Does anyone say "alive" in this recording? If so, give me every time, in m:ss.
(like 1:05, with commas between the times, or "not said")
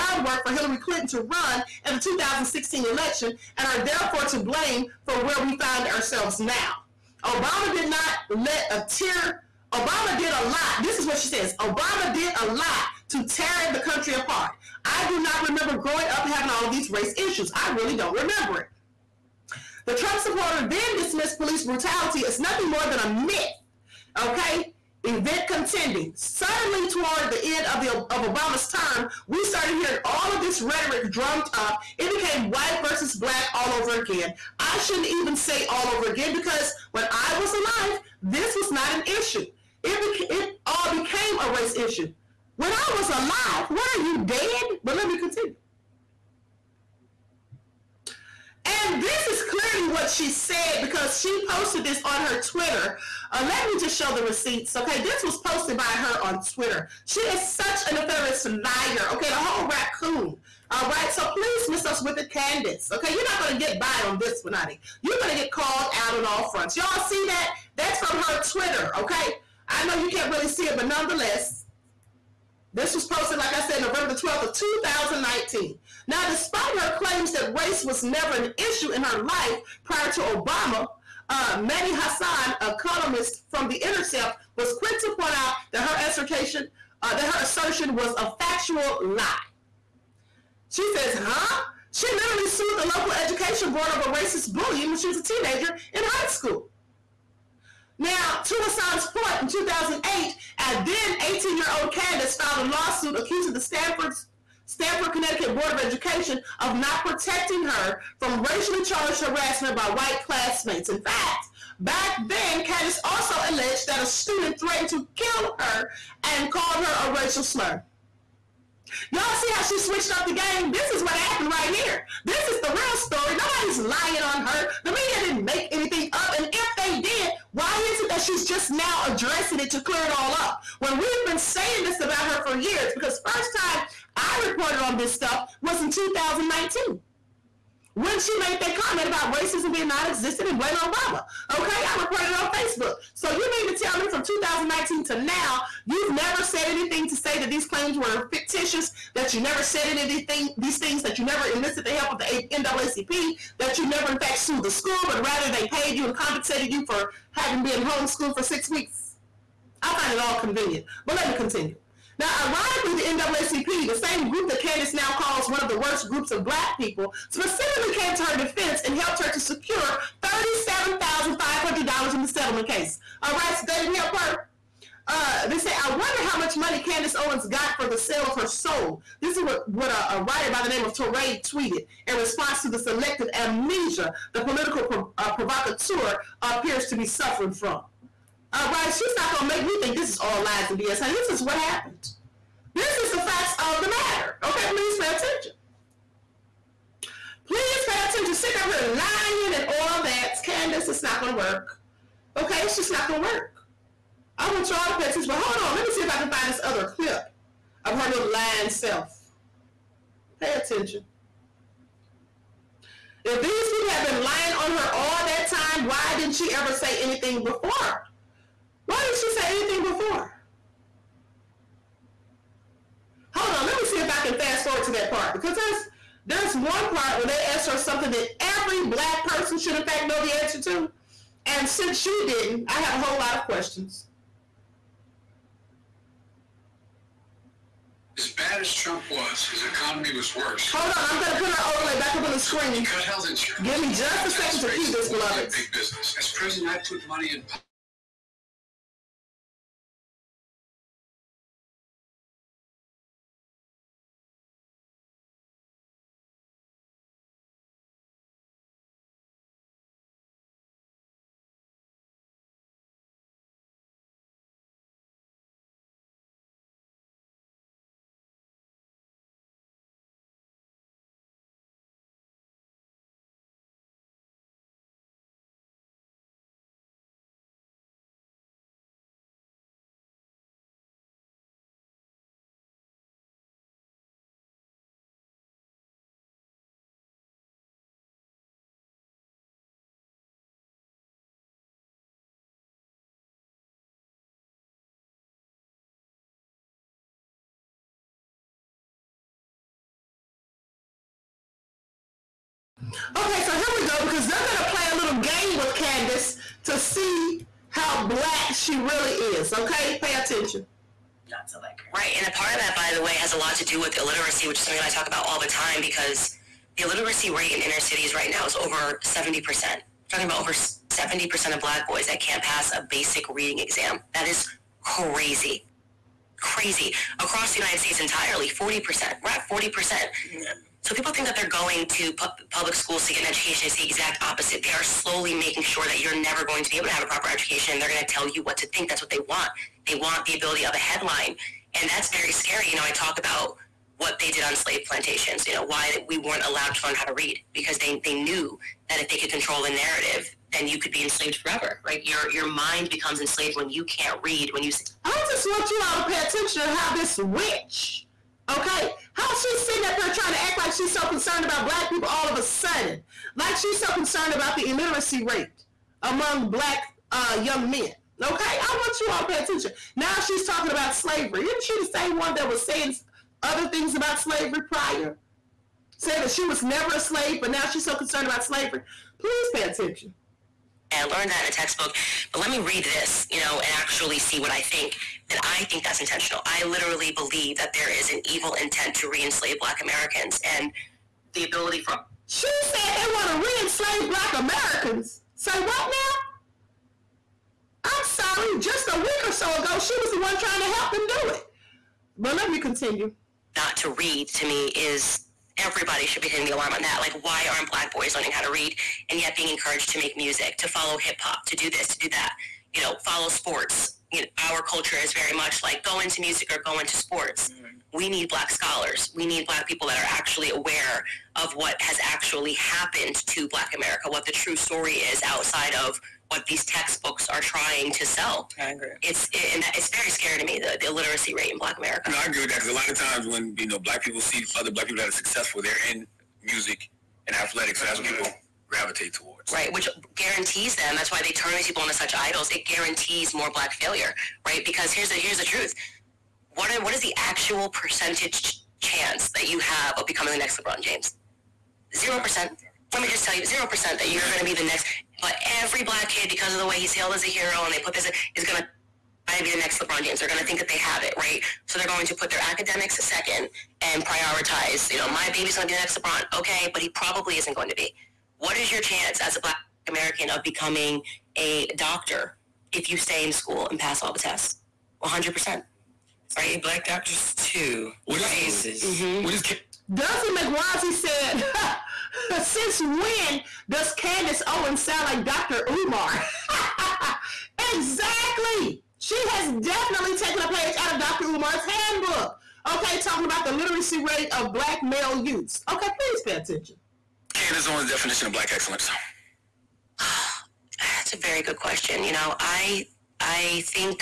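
0:37, 0:43.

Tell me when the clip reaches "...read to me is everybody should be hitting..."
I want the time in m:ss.
6:43.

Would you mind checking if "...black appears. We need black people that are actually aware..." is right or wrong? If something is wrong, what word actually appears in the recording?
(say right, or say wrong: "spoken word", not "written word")
wrong: "scholars", not "appears".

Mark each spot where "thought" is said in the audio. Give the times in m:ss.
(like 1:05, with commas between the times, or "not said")
not said.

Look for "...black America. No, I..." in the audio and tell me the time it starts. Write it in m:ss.
7:11.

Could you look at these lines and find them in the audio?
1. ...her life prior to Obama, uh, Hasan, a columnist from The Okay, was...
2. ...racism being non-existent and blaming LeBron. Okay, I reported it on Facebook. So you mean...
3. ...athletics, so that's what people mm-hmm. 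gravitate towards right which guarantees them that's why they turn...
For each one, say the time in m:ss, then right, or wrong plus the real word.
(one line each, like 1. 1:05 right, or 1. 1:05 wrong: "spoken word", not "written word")
1. 1:19 wrong: "Intercept", not "Okay"
2. 2:19 wrong: "Obama", not "LeBron"
3. 7:17 right.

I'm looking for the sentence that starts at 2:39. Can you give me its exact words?
I find it all convenient, but let me continue.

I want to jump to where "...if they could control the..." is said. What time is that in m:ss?
5:48.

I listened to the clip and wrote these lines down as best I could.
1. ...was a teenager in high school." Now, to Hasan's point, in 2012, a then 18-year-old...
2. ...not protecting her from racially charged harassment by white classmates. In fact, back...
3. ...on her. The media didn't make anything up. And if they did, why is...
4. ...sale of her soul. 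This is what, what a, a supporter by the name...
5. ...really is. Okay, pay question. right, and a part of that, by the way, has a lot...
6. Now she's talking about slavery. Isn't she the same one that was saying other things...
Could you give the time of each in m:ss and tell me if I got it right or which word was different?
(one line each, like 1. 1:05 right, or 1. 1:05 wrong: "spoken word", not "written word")
1. 1:35 wrong: "2008", not "2012"
2. 1:46 right
3. 2:04 right
4. 2:57 wrong: "writer", not "supporter"
5. 5:08 wrong: "attention", not "question"
6. 6:09 right.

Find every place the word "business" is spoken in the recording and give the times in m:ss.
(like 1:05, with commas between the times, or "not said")
4:05.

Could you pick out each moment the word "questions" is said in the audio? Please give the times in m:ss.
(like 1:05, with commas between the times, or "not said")
3:53, 8:21.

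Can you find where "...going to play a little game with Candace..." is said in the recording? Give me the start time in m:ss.
5:04.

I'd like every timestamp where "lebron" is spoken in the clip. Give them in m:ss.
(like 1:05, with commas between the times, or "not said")
7:30, 7:39, 7:45.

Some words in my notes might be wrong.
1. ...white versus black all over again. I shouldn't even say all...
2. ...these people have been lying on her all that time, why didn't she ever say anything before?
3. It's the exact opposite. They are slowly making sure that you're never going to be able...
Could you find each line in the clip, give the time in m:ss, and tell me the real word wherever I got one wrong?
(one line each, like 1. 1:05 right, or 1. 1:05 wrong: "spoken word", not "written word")
1. 0:32 right
2. 3:33 right
3. 5:33 right.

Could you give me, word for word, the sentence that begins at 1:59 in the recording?
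Y'all see how she switched up the game?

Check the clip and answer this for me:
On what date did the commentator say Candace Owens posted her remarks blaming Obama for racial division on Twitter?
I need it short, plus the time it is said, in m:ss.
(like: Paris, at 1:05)
November 12, 2019, at 1:13.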